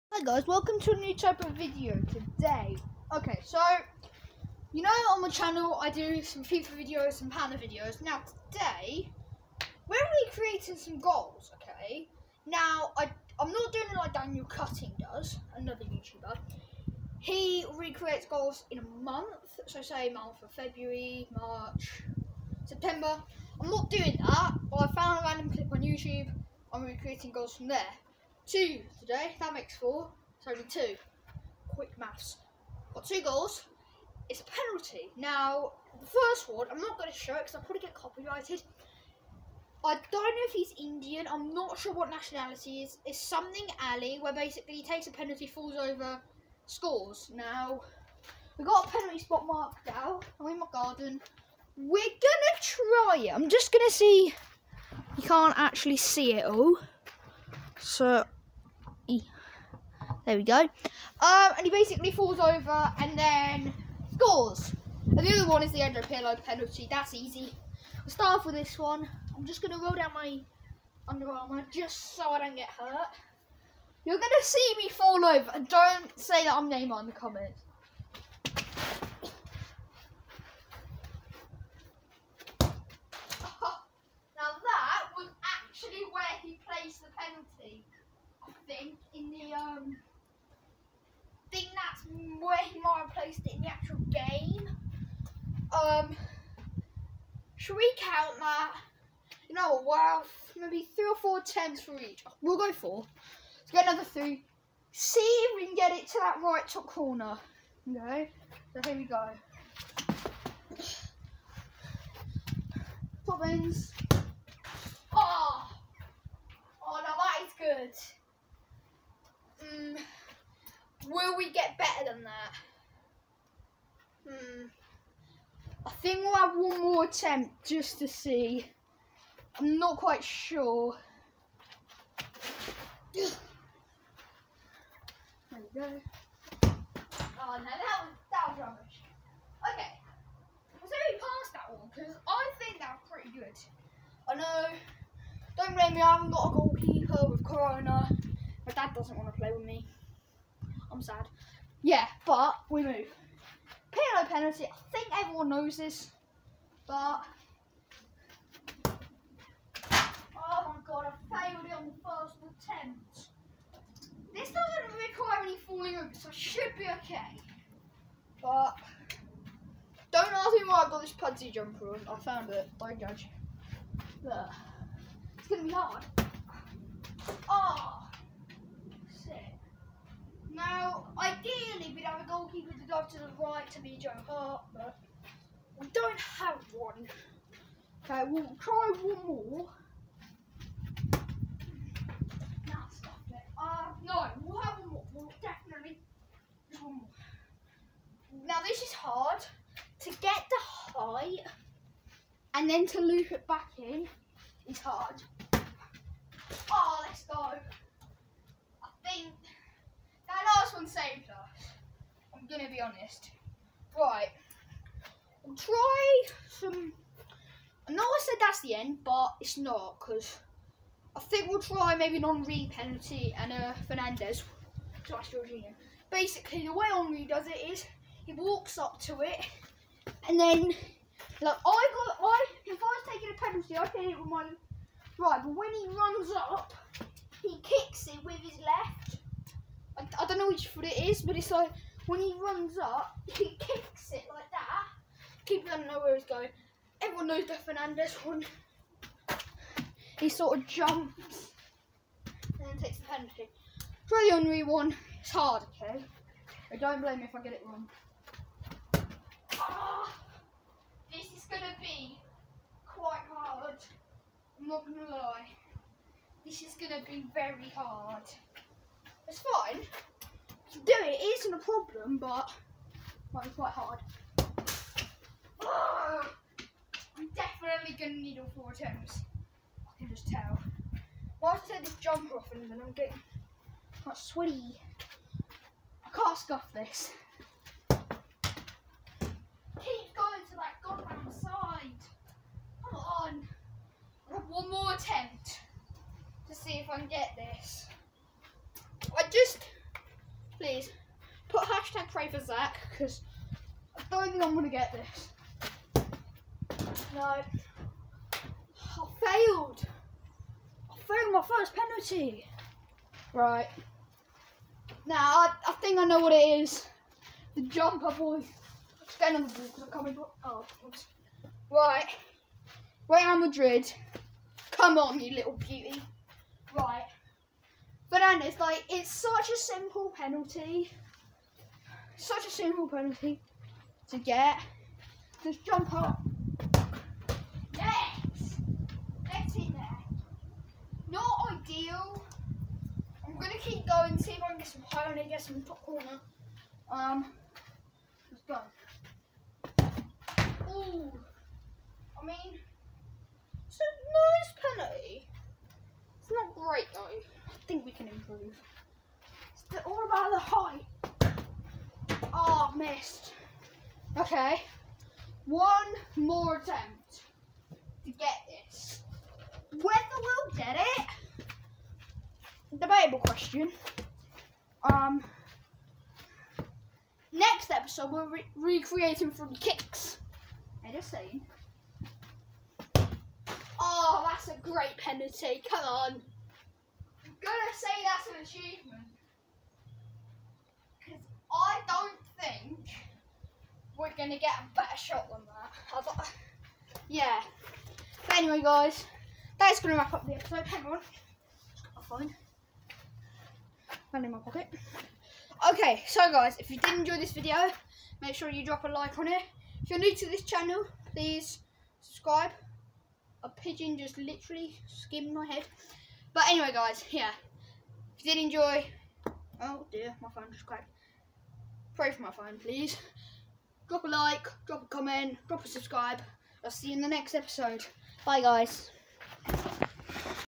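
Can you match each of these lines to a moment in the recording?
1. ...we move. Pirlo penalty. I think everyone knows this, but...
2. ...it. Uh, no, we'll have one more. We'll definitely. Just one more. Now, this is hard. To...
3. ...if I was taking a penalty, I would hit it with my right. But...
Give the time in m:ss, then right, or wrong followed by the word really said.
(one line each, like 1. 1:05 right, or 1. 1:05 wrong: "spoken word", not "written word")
1. 2:32 right
2. 3:13 right
3. 3:52 right.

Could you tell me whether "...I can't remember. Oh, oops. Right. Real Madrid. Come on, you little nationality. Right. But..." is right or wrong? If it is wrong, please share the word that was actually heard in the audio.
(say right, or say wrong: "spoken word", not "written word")
wrong: "beauty", not "nationality".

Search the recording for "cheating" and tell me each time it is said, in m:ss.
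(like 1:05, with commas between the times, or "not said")
not said.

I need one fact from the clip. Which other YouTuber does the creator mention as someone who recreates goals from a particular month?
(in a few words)
Daniel Cutting.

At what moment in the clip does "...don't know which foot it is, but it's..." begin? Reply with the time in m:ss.
4:00.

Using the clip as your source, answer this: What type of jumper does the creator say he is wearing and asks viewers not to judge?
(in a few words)
Pudsey jumper.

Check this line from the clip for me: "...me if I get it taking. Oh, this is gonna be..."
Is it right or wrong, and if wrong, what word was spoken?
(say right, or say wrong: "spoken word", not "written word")
wrong: "wrong", not "taking".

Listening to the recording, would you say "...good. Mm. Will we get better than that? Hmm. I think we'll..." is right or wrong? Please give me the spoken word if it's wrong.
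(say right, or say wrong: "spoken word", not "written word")
right.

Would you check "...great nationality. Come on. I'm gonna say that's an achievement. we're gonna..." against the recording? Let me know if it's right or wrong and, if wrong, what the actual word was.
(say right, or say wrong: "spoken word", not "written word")
wrong: "penalty", not "nationality".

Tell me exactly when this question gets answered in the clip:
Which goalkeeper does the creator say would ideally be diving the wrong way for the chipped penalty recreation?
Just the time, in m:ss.
3:03.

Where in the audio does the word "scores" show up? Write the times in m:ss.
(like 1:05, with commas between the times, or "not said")
0:46, 1:04.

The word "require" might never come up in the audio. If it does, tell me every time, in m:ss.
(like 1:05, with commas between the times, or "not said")
2:45.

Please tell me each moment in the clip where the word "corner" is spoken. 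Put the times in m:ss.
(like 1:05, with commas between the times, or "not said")
1:46, 5:45.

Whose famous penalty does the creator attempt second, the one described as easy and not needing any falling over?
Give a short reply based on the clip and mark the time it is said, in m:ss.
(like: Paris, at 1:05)
Andrea Pirlo, at 1:05.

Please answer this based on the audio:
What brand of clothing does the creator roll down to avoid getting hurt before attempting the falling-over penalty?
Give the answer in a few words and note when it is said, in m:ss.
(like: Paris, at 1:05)
Under Armour, at 1:11.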